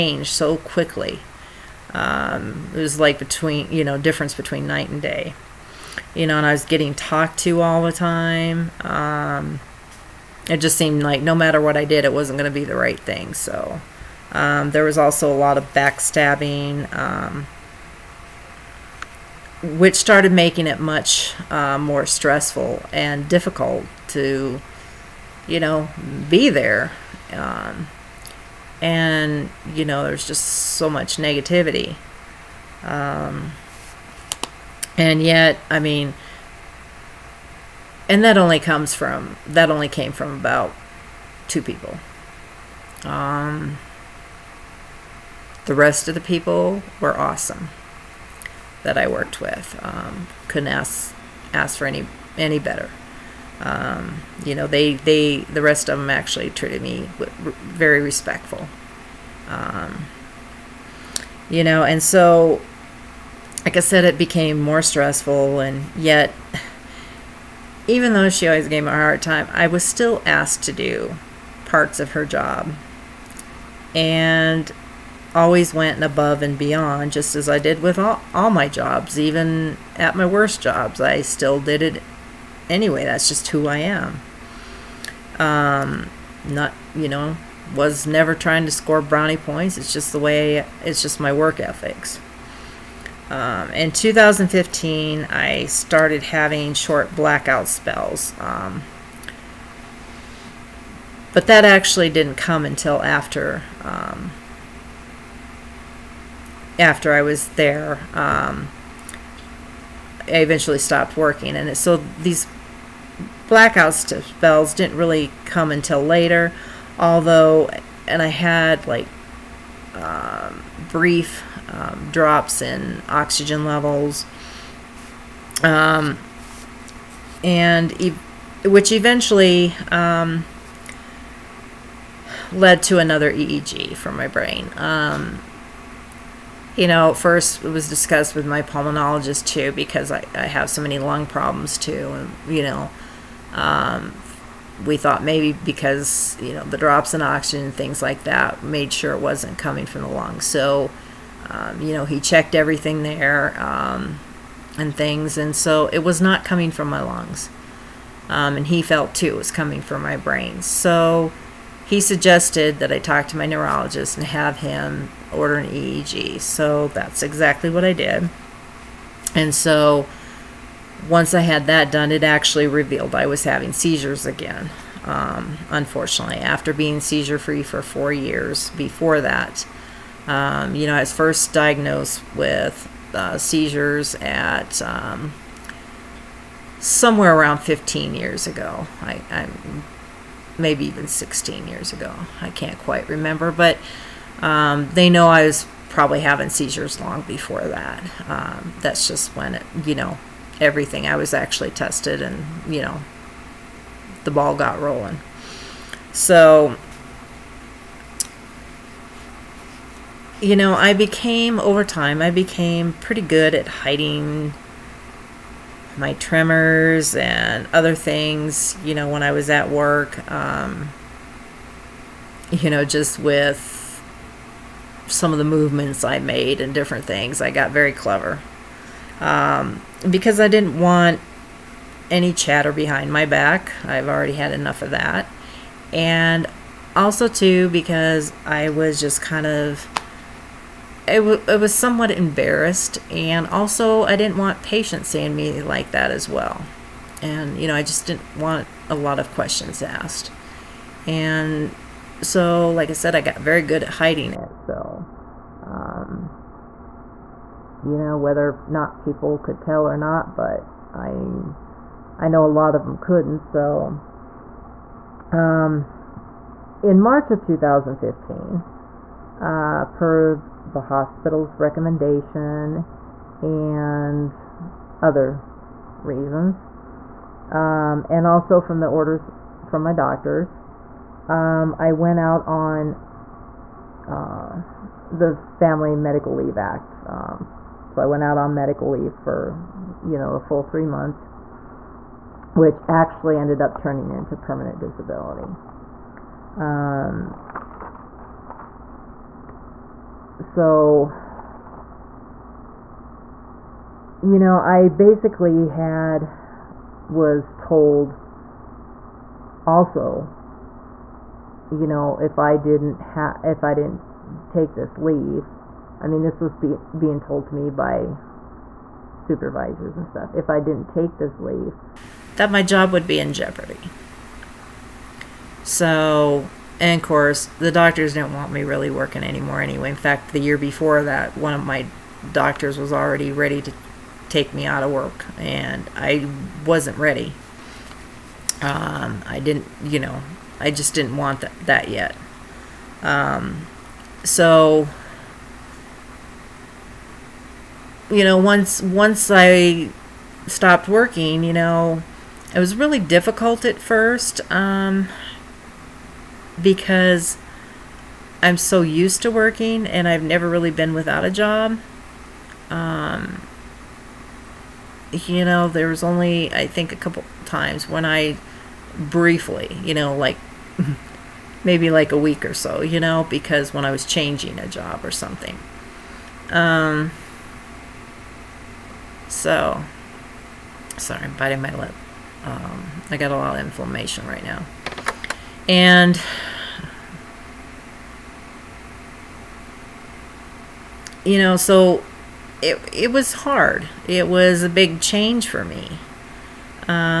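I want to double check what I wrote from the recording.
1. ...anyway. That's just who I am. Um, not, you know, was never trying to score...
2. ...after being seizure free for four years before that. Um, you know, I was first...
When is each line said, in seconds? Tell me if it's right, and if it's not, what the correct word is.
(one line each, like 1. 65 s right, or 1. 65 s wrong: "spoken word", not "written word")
1. 82 s right
2. 176 s right.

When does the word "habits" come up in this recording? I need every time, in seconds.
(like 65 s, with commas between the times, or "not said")
not said.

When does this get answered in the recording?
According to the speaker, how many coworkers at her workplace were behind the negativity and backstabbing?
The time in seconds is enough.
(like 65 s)
41 s.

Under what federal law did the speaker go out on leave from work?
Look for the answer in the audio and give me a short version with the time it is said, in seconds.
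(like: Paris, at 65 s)
Family Medical Leave Act, at 285 s.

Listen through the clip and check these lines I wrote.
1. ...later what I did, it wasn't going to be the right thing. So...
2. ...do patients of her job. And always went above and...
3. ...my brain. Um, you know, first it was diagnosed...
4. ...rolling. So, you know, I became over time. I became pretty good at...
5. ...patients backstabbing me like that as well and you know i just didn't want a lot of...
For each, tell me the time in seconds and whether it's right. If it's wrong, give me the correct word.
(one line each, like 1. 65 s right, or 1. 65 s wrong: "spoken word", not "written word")
1. 11 s wrong: "matter", not "later"
2. 70 s wrong: "parts", not "patients"
3. 134 s wrong: "discussed", not "diagnosed"
4. 204 s right
5. 244 s wrong: "seeing", not "backstabbing".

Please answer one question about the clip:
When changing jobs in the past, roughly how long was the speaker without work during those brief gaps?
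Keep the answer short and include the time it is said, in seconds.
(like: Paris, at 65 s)
A week, at 372 s.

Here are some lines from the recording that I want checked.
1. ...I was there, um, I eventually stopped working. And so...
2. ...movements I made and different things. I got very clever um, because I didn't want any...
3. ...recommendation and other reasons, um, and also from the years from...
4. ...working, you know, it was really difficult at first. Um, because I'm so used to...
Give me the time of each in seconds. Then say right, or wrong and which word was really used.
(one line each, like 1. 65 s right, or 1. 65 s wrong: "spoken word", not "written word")
1. 107 s right
2. 225 s right
3. 271 s wrong: "orders", not "years"
4. 350 s right.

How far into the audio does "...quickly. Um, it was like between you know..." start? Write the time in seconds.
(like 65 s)
0 s.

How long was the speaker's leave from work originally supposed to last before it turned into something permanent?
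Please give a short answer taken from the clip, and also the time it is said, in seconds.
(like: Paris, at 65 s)
3 months, at 290 s.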